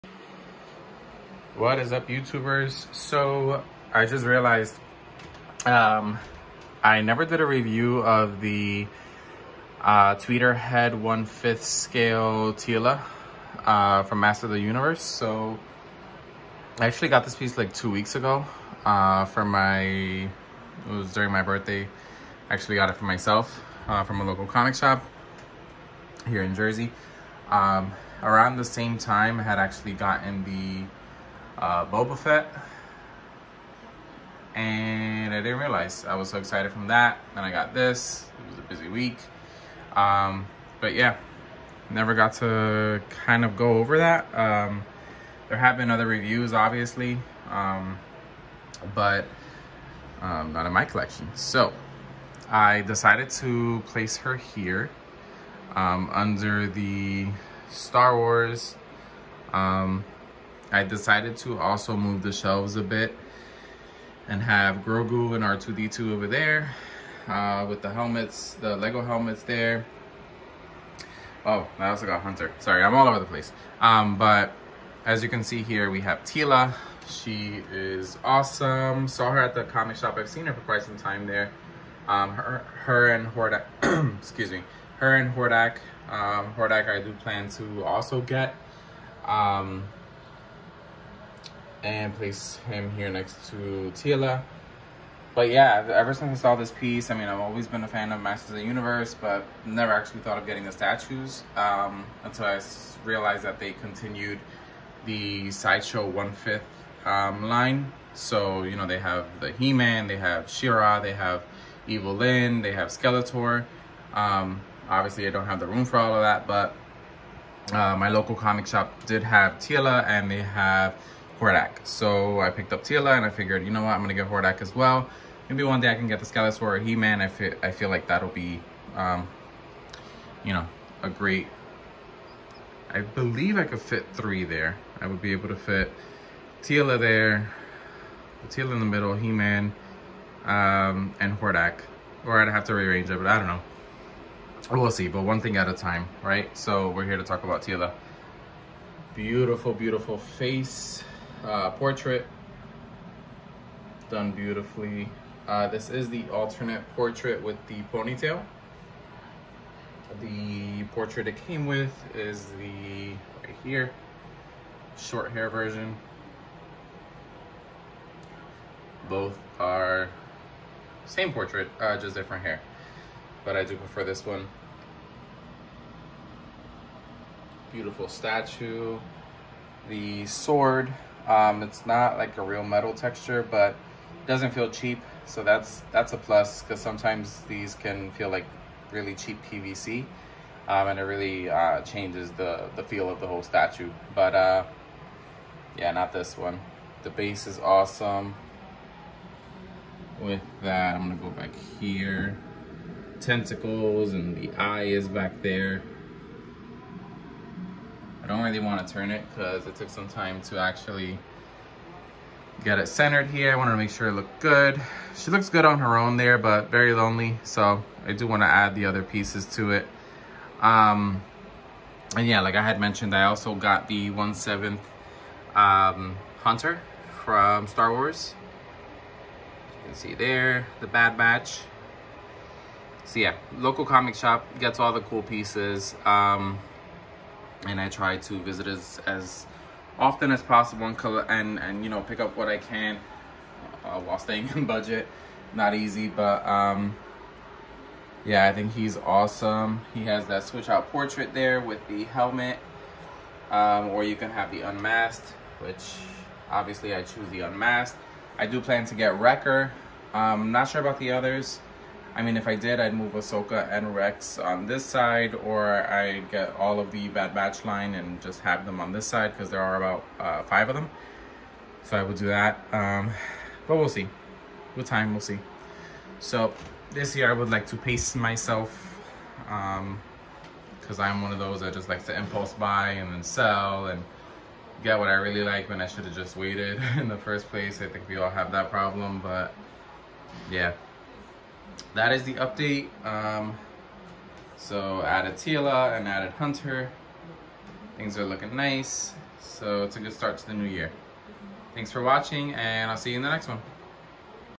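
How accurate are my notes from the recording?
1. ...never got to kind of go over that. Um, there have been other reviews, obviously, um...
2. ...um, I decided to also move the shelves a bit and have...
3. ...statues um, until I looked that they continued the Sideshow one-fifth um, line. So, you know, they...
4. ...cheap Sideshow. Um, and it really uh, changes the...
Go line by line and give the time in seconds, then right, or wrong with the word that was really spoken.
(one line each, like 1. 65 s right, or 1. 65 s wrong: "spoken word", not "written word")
1. 41 s right
2. 59 s right
3. 100 s wrong: "realized", not "looked"
4. 189 s wrong: "PVC", not "Sideshow".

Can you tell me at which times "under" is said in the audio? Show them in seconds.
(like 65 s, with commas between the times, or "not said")
56 s.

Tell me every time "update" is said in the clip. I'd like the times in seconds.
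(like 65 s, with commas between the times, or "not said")
292 s.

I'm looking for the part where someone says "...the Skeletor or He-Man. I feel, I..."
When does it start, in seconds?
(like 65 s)
126 s.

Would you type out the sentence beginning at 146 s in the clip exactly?
So we're here to talk about Teela.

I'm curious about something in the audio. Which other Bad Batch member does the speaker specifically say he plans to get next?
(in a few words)
Wrecker.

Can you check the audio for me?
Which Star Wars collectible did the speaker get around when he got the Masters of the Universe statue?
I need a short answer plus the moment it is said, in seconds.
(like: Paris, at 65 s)
Boba Fett, at 31 s.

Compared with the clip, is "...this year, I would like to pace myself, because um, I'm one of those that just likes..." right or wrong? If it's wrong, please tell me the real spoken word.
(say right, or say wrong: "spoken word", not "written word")
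right.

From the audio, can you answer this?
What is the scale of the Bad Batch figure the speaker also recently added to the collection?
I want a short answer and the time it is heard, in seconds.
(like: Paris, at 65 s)
1/7, at 224 s.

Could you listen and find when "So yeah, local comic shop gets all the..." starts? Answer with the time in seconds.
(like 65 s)
233 s.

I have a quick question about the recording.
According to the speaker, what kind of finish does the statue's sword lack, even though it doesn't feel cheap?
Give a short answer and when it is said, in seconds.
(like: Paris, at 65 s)
real metal texture, at 182 s.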